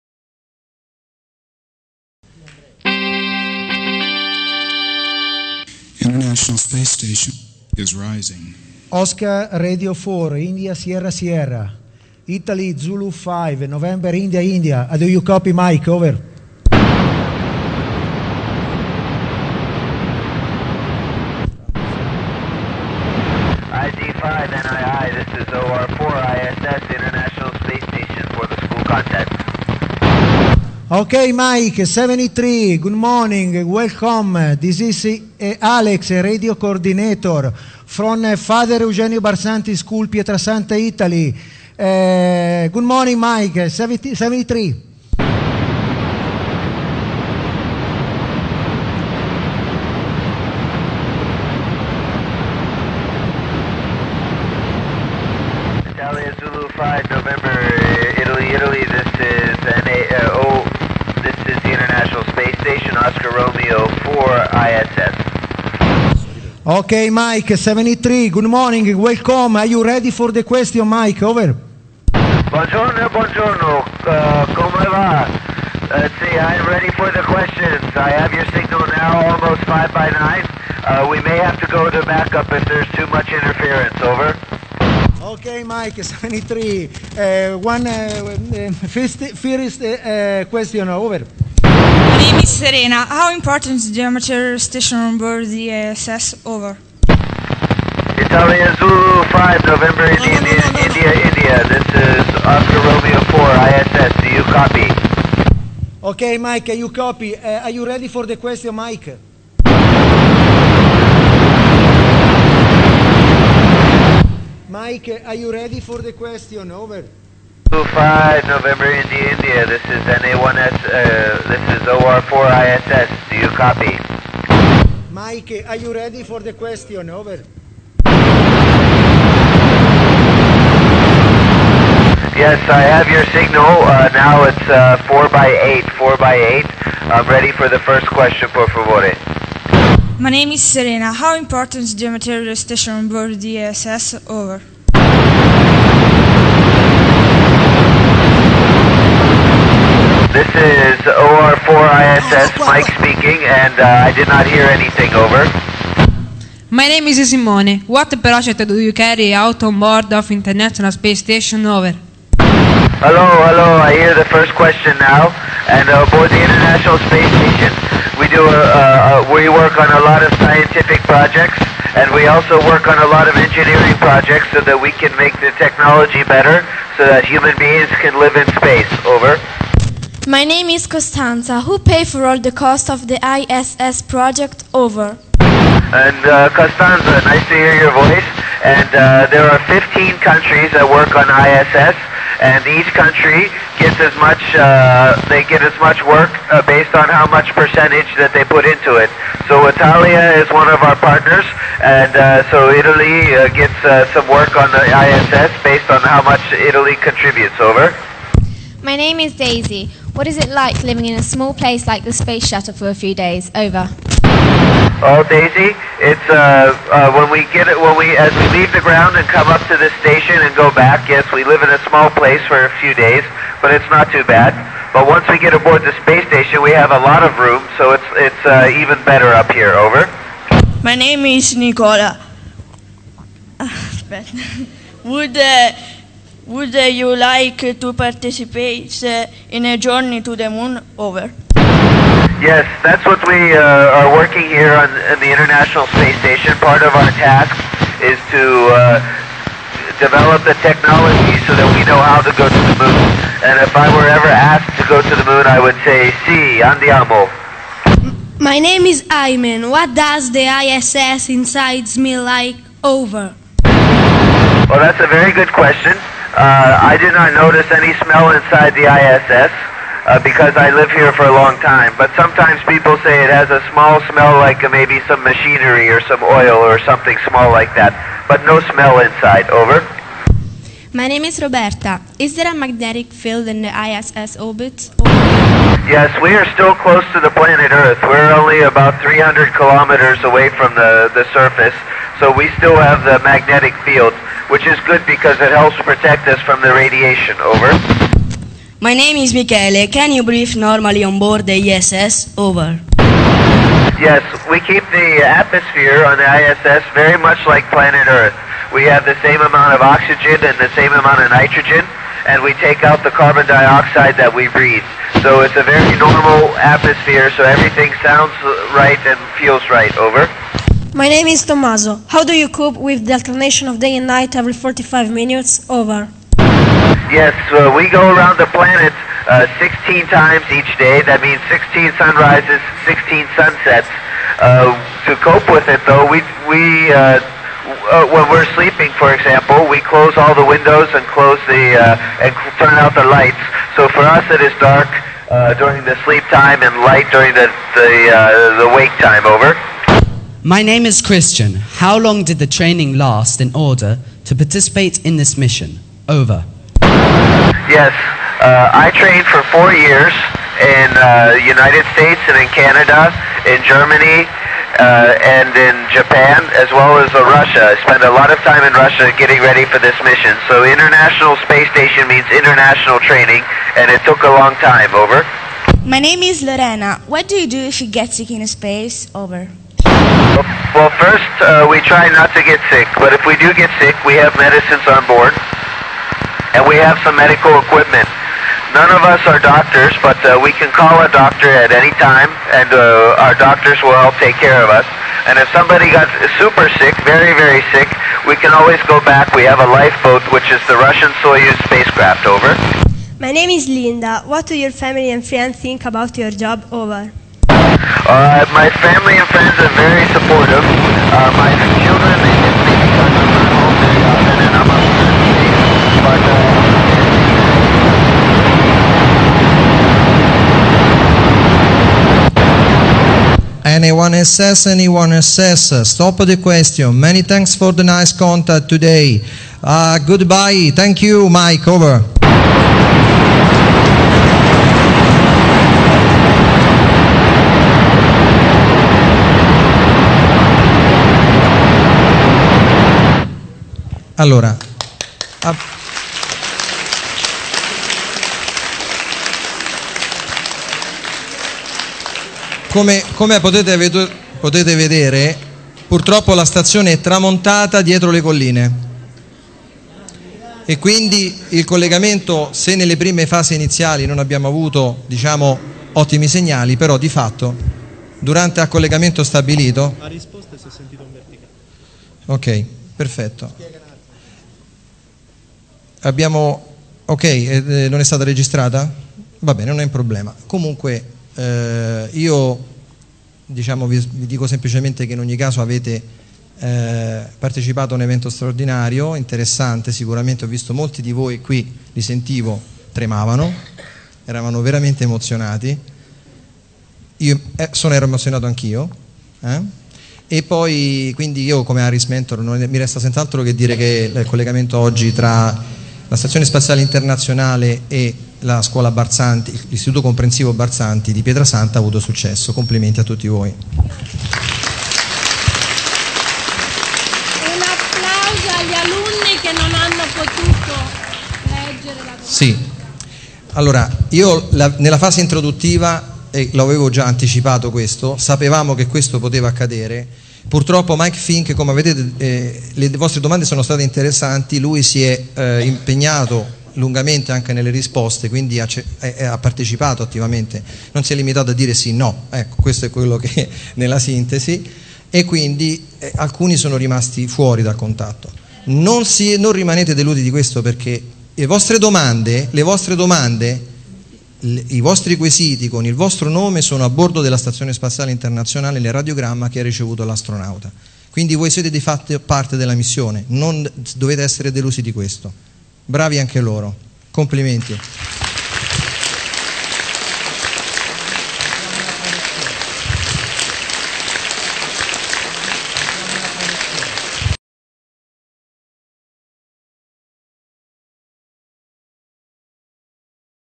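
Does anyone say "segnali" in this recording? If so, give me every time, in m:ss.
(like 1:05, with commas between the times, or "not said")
7:46.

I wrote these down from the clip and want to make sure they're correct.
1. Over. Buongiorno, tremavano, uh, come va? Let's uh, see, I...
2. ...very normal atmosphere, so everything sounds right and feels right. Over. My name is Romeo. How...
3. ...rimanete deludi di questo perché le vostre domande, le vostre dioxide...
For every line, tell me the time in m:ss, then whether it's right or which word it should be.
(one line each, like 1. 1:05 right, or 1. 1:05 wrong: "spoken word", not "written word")
1. 1:11 wrong: "buongiorno", not "tremavano"
2. 5:15 wrong: "Tommaso", not "Romeo"
3. 9:09 wrong: "domande", not "dioxide".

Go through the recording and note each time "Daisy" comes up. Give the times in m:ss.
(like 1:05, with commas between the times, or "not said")
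3:29, 3:35.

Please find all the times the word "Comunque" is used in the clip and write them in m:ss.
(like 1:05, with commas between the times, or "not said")
8:00.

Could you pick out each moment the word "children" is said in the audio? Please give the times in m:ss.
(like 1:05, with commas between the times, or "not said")
6:51.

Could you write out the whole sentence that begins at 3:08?
And uh, there are 15 countries that work on ISS, and each country gets as much.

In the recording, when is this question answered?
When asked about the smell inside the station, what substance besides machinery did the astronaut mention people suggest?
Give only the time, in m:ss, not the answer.
4:36.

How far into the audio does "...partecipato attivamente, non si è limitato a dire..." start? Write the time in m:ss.
8:59.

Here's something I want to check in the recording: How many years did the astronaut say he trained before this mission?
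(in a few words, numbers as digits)
Four years.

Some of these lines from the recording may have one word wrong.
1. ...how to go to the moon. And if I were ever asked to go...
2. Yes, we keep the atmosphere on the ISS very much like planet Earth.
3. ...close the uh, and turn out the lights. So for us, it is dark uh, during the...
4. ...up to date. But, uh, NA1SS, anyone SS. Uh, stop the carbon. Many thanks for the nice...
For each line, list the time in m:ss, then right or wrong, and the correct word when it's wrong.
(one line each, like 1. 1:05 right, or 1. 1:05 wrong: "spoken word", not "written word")
1. 4:12 right
2. 5:04 right
3. 5:41 right
4. 6:54 wrong: "question", not "carbon".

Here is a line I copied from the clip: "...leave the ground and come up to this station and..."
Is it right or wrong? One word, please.
right.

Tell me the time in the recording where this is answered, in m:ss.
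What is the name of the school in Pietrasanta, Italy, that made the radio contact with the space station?
0:38.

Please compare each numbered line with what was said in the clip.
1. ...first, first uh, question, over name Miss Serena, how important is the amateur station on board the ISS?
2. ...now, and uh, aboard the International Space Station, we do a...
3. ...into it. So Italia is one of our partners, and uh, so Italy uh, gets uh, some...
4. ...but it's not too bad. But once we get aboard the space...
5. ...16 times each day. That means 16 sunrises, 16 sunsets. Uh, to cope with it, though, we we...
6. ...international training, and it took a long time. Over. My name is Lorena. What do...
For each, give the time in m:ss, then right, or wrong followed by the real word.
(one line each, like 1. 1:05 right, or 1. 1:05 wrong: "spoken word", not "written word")
1. 1:28 right
2. 2:44 right
3. 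3:18 right
4. 3:43 right
5. 5:29 right
6. 6:12 right.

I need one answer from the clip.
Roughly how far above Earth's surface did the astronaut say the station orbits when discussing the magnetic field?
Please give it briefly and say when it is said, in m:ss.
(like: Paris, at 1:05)
300 kilometers, at 4:48.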